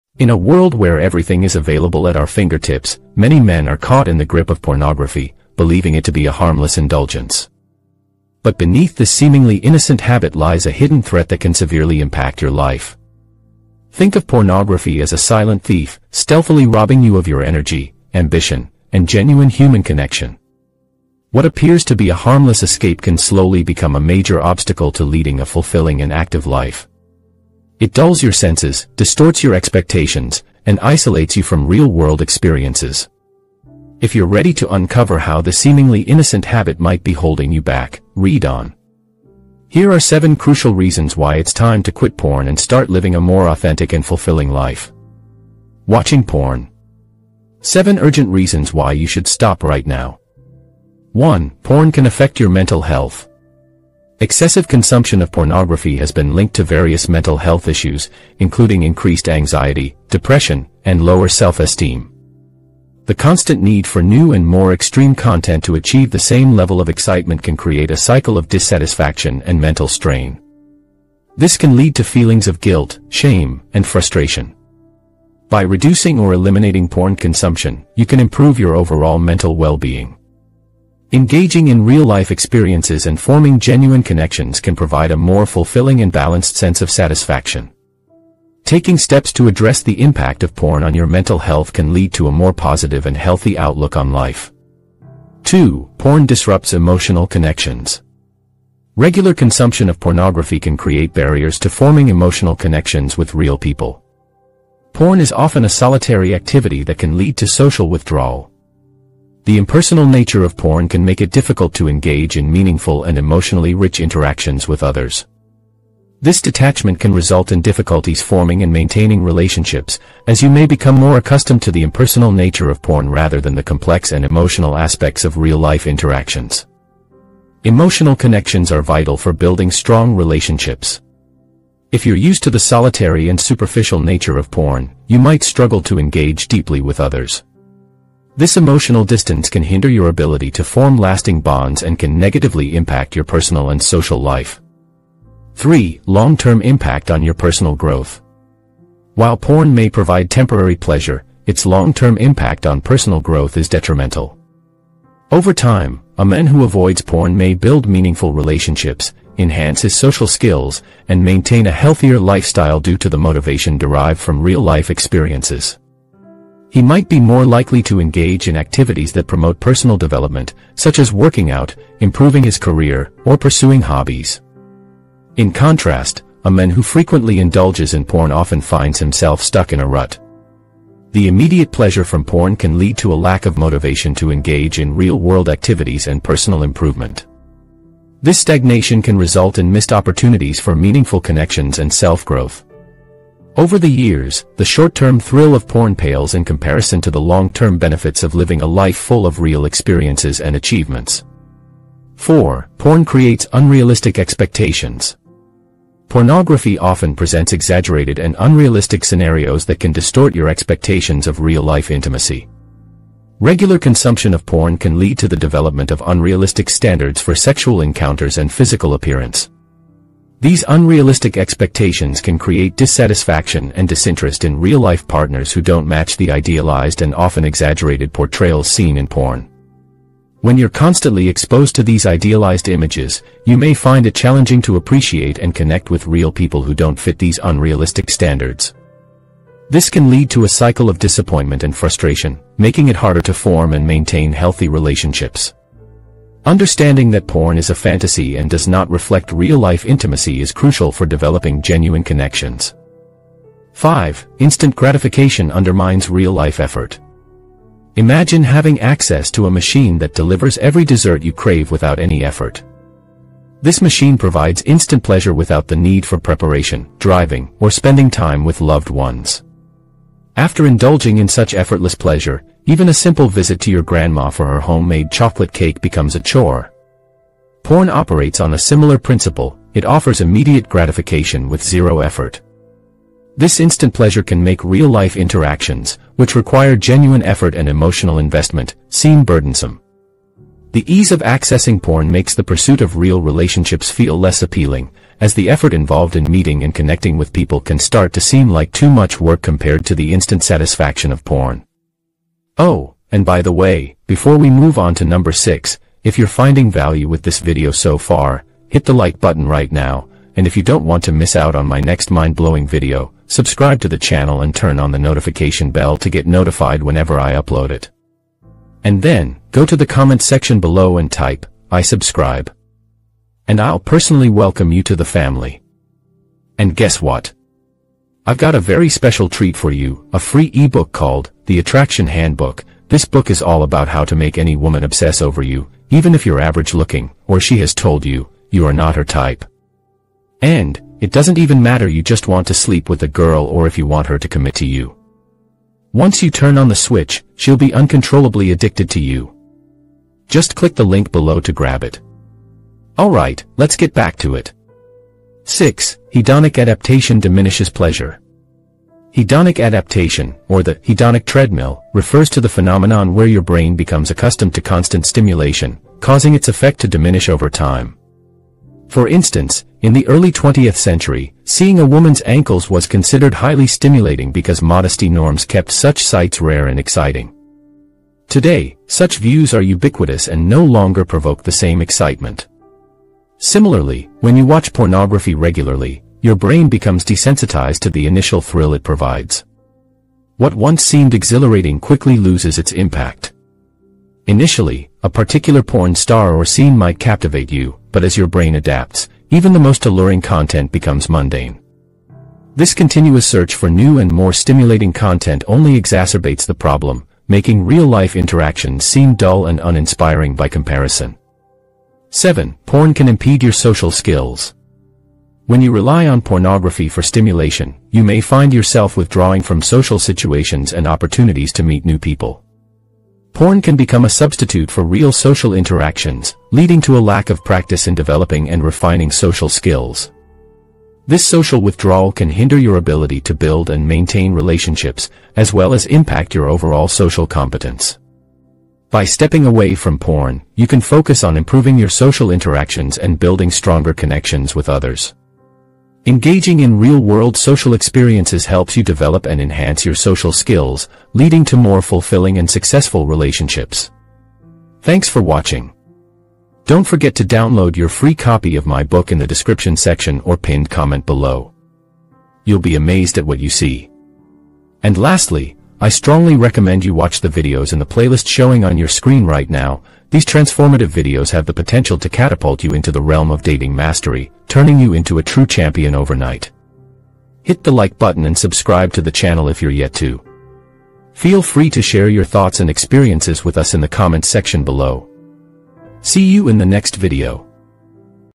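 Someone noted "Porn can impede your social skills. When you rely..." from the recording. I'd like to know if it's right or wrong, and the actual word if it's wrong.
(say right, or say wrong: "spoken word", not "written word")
right.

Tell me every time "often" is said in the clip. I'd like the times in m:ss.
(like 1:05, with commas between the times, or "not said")
1:45, 2:58, 3:26, 3:47.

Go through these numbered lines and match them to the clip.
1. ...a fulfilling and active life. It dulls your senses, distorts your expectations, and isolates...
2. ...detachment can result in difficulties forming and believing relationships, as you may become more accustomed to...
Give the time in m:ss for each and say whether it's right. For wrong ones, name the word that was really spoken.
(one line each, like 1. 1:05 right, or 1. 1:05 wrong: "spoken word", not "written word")
1. 0:25 right
2. 1:56 wrong: "maintaining", not "believing".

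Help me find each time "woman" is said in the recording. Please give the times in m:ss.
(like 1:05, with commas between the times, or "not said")
5:34, 6:11.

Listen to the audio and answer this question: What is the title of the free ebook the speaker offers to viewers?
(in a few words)
The Attraction Handbook.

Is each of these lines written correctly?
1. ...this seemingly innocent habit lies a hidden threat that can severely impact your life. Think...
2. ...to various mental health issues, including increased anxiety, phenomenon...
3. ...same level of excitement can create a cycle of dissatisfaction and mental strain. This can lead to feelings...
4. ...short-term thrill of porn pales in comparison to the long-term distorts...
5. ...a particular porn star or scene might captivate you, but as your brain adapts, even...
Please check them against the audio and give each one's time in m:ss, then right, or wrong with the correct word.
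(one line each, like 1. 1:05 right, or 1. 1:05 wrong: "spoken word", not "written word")
1. 0:08 right
2. 0:56 wrong: "depression", not "phenomenon"
3. 1:06 right
4. 3:14 wrong: "benefits", not "distorts"
5. 6:35 right.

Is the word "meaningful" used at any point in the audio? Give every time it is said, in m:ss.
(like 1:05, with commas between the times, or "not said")
1:52, 2:37, 3:10.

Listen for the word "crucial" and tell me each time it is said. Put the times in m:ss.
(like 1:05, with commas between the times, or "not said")
0:40, 4:10.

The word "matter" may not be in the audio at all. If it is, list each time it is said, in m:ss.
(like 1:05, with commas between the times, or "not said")
5:41.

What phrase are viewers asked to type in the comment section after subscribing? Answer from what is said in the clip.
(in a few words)
I subscribe.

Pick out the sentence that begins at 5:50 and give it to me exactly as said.
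Just click the link below to grab it.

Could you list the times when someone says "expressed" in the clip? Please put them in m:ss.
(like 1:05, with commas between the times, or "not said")
not said.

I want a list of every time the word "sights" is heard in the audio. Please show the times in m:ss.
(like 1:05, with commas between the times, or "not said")
6:16.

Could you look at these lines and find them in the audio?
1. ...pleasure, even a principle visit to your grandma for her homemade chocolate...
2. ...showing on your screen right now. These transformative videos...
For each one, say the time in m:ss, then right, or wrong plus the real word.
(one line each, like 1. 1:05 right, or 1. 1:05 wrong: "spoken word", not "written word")
1. 4:31 wrong: "simple", not "principle"
2. 7:48 right.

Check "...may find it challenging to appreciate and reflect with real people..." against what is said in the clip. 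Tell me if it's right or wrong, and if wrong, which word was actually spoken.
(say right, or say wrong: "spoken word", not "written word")
wrong: "connect", not "reflect".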